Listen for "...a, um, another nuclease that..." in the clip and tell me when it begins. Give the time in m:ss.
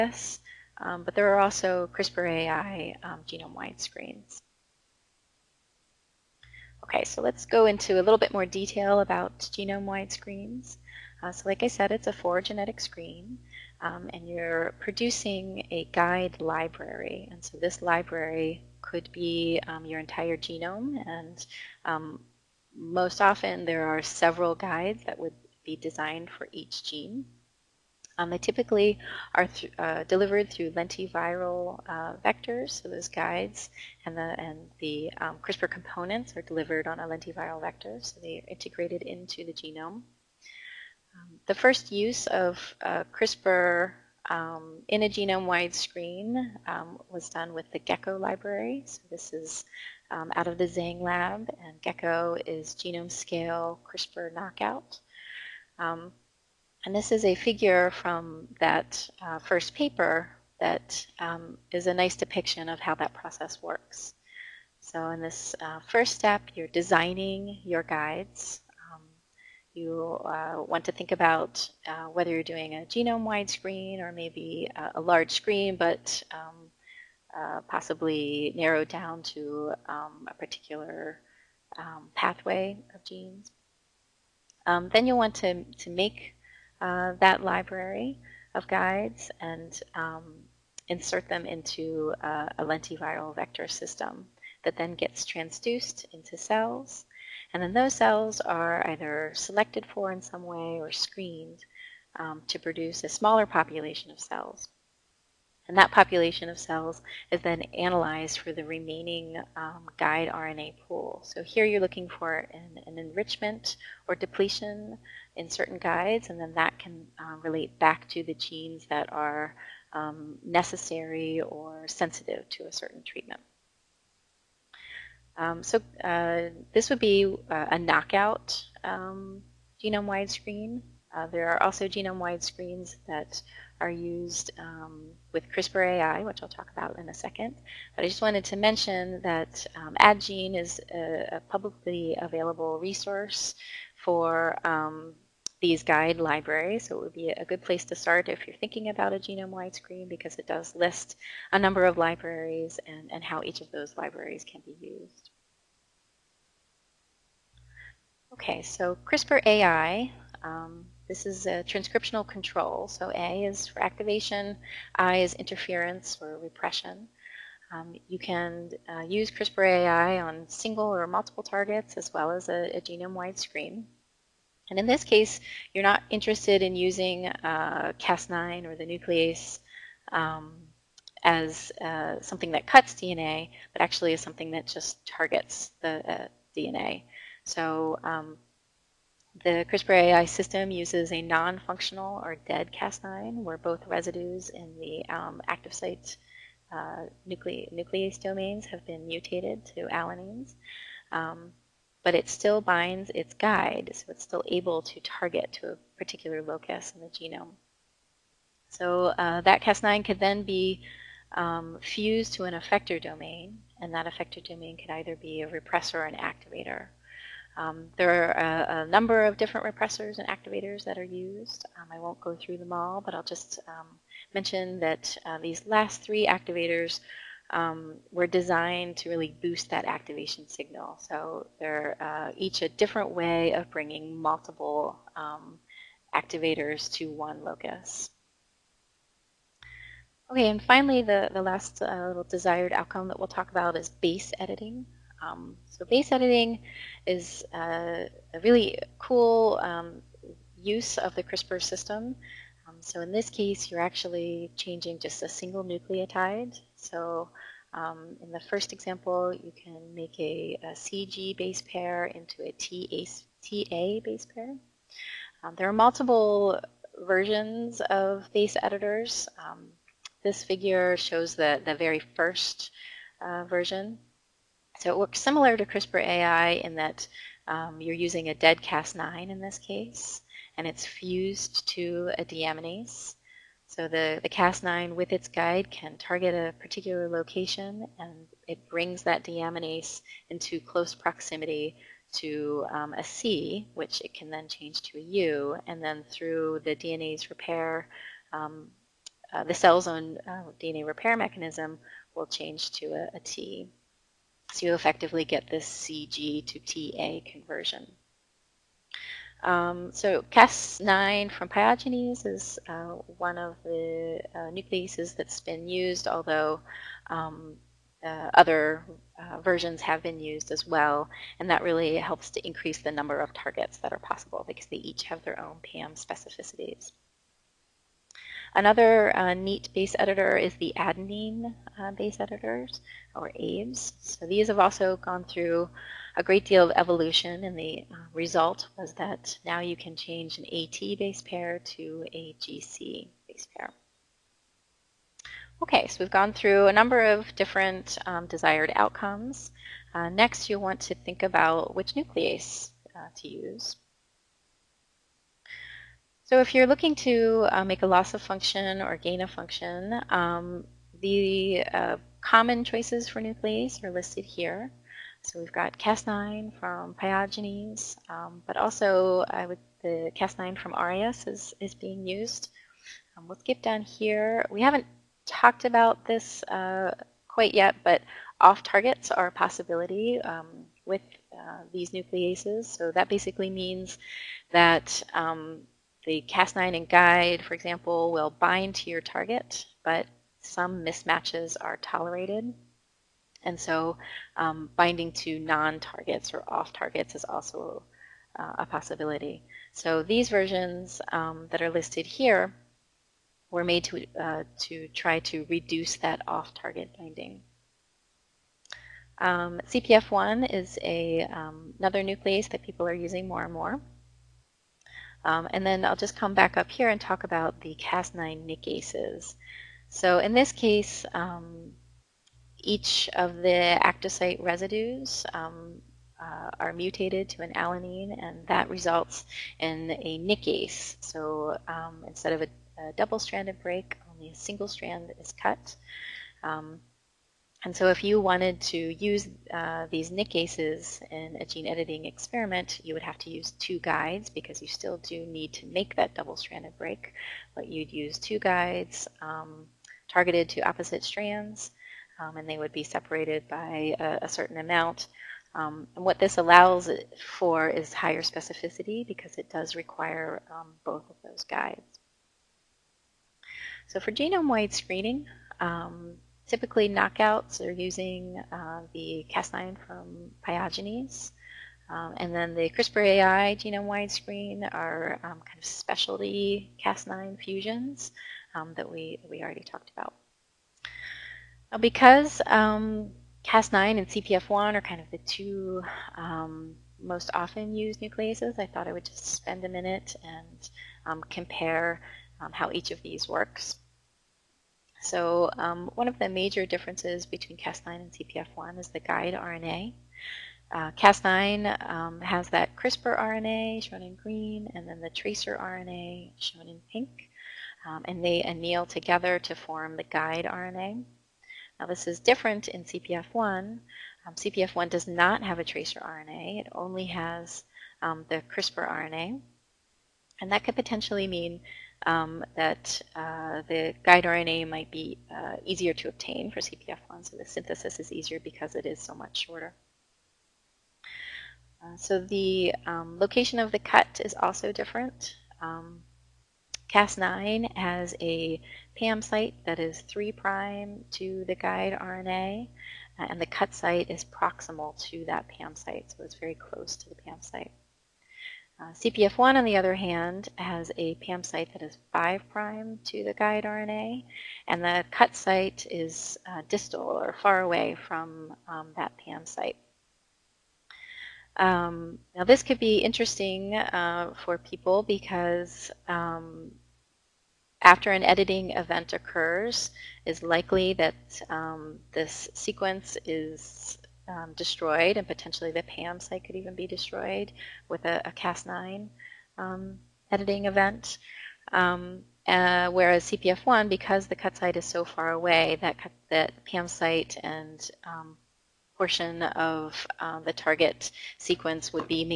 6:50.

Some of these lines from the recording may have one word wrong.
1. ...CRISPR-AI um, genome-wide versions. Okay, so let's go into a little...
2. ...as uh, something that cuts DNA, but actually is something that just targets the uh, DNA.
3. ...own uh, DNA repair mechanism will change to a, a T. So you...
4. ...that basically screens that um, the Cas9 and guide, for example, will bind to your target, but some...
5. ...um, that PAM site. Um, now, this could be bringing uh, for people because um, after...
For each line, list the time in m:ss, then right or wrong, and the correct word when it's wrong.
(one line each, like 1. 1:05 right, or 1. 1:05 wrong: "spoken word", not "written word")
1. 0:01 wrong: "screens", not "versions"
2. 3:01 right
3. 4:59 right
4. 6:22 wrong: "means", not "screens"
5. 9:18 wrong: "interesting", not "bringing".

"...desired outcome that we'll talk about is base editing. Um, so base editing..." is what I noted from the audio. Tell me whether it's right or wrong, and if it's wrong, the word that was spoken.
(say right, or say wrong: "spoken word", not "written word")
right.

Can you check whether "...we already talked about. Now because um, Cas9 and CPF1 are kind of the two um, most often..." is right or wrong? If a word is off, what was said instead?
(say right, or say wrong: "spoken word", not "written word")
right.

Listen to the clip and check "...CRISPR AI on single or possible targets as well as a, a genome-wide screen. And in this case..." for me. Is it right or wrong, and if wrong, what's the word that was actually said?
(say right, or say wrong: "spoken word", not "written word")
wrong: "multiple", not "possible".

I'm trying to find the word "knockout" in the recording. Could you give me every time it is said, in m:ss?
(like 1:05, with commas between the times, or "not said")
0:54, 2:07, 7:46.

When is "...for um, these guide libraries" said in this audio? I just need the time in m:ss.
2:24.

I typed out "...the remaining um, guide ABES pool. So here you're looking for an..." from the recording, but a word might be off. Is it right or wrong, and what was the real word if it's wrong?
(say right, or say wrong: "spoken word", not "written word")
wrong: "RNA", not "ABES".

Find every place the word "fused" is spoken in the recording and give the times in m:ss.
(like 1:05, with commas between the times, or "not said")
3:31, 4:40.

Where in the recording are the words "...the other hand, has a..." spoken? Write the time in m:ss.
9:09.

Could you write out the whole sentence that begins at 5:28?
Another uh, neat base editor is the adenine uh, base editors, or ABES.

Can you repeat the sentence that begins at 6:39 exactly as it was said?
So these versions um, that are listed here were made to, uh, to try to reduce that off-target binding.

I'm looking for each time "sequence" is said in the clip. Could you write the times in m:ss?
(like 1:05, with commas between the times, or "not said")
9:32, 9:51.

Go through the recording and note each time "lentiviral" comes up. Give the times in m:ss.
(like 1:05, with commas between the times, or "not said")
0:30, 0:37, 1:32.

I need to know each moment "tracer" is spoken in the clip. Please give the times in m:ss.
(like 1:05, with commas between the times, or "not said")
8:25, 8:35.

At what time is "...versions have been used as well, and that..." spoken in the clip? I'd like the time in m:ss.
5:19.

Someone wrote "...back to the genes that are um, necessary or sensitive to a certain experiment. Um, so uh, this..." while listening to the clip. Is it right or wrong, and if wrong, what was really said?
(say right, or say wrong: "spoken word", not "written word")
wrong: "treatment", not "experiment".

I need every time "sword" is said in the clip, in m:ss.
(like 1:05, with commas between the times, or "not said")
not said.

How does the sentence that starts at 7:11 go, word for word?
So um, instead of a, a double-stranded break, only a single strand is cut.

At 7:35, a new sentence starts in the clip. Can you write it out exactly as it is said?
Um, and what this allows for is higher specificity because it does require um, both of those guides.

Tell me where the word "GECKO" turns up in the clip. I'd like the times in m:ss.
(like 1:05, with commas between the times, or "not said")
0:47, 0:51.